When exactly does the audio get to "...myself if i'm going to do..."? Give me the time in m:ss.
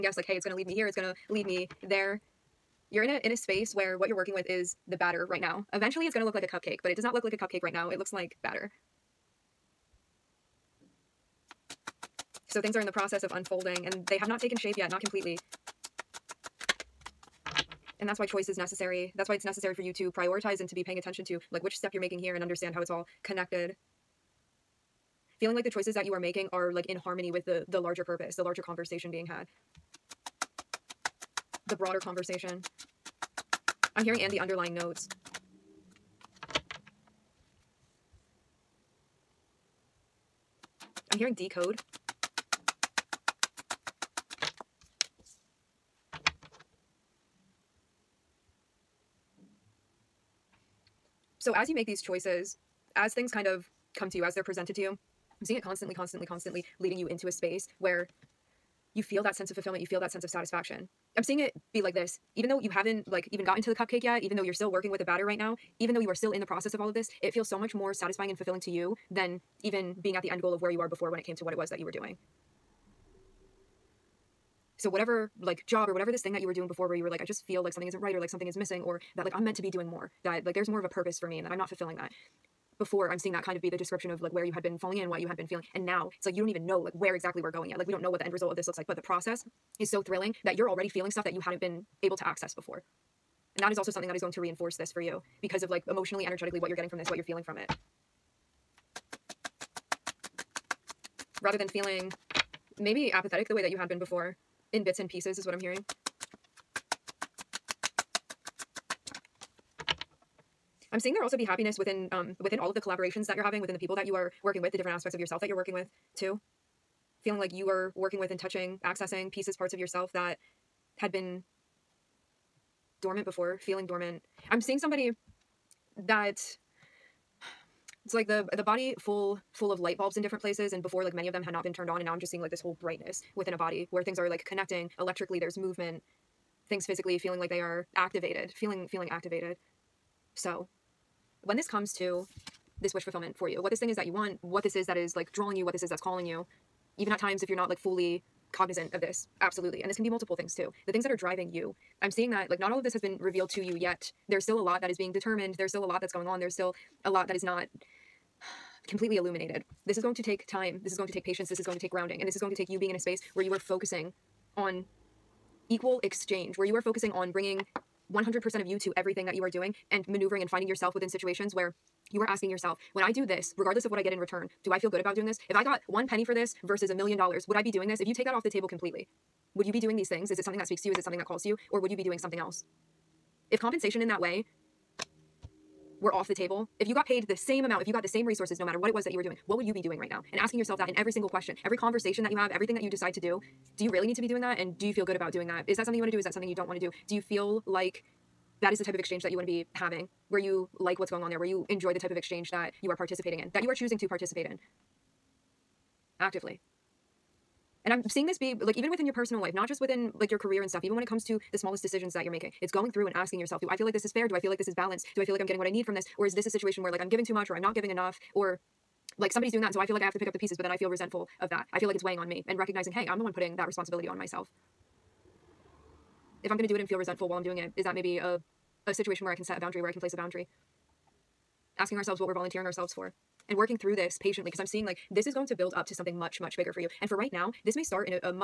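3:44.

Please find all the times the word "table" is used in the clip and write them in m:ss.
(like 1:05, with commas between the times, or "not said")
2:58, 3:06.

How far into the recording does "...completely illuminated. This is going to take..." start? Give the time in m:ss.
2:38.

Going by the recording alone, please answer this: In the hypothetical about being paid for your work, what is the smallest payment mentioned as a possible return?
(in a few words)
one penny.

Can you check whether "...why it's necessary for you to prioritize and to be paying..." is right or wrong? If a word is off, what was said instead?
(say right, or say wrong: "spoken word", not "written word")
right.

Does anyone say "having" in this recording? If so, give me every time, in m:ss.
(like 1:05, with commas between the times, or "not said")
1:53, 3:19.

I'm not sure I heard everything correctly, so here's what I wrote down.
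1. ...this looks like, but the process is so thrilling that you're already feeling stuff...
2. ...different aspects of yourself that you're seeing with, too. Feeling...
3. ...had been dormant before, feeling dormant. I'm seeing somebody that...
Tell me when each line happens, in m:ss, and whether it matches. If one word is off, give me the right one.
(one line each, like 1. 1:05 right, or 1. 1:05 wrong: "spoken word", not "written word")
1. 1:28 right
2. 1:54 wrong: "working", not "seeing"
3. 2:00 right.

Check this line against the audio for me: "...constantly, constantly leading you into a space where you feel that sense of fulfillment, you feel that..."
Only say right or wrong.
right.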